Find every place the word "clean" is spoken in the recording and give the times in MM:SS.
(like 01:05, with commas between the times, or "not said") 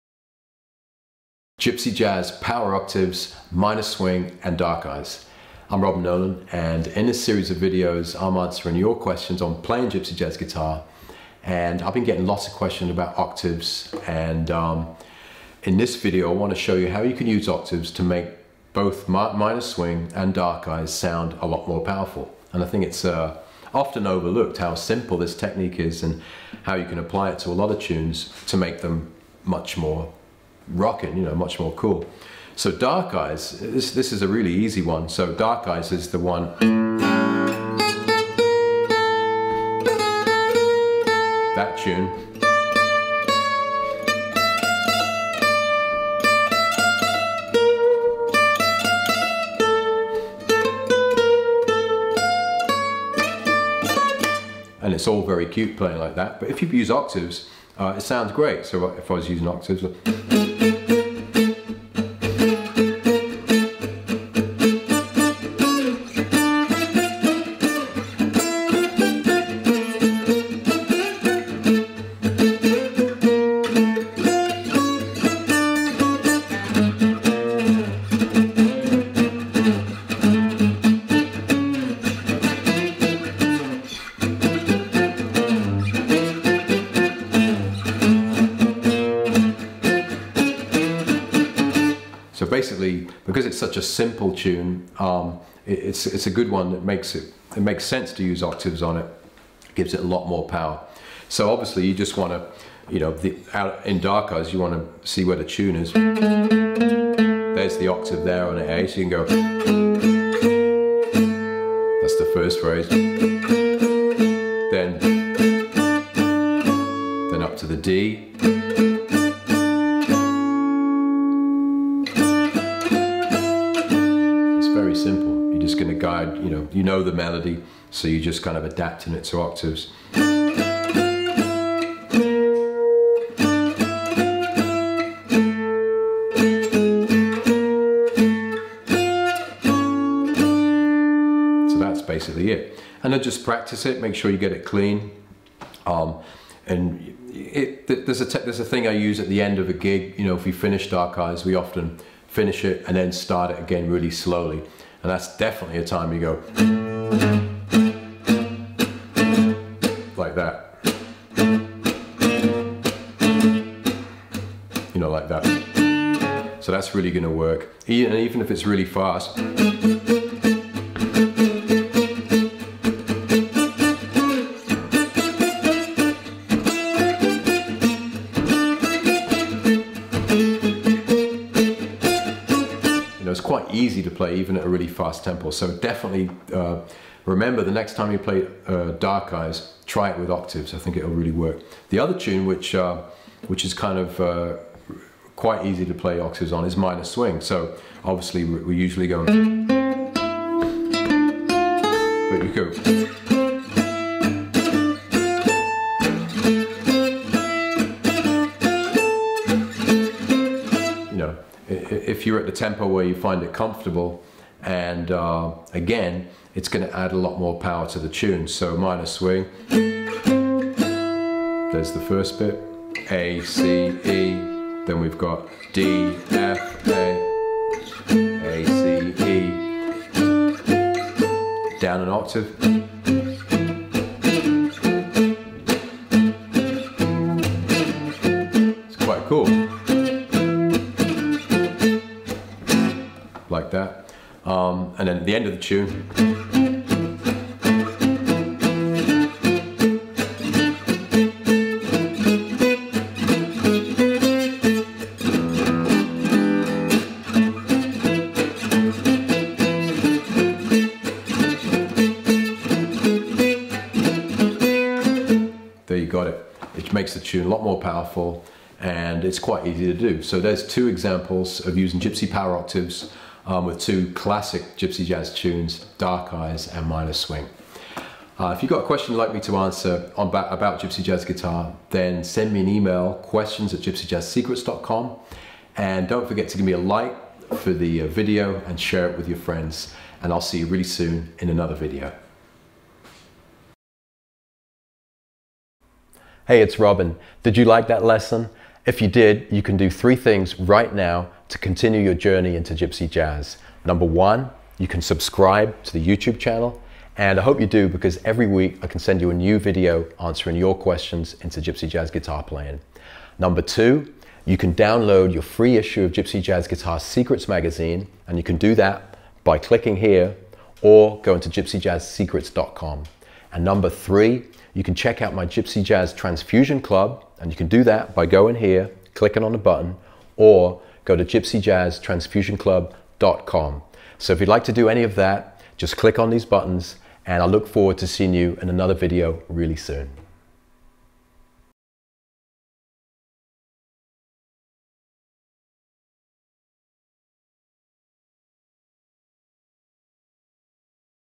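02:24.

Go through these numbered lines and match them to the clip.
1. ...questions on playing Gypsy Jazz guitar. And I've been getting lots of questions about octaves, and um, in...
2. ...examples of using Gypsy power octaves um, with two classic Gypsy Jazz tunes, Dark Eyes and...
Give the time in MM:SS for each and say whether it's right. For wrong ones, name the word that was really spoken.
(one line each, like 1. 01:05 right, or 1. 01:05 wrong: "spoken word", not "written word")
1. 00:08 right
2. 04:30 right.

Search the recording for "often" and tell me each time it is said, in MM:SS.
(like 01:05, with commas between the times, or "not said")
00:23, 02:31.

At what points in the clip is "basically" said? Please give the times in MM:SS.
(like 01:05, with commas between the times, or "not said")
01:32, 02:22.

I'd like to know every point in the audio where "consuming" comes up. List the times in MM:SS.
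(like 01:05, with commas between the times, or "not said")
not said.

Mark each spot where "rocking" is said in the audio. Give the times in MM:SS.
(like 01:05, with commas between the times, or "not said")
00:30.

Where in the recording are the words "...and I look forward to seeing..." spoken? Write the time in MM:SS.
05:37.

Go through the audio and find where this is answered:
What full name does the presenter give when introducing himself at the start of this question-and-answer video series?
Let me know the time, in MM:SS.
00:05.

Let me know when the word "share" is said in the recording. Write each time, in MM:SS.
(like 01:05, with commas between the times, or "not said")
04:48.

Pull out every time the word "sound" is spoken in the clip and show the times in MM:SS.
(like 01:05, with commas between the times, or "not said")
00:20, 00:58.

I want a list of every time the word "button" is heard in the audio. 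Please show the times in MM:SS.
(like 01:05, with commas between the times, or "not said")
05:29, 05:36.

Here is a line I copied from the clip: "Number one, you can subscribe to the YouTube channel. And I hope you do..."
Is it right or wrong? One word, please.
right.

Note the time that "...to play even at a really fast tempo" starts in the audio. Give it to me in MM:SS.
03:04.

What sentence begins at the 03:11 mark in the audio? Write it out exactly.
The other tune, which uh, which is kind of uh, quite easy to play octaves on, is Minor Swing.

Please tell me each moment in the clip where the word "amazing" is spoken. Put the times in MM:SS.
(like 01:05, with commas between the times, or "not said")
not said.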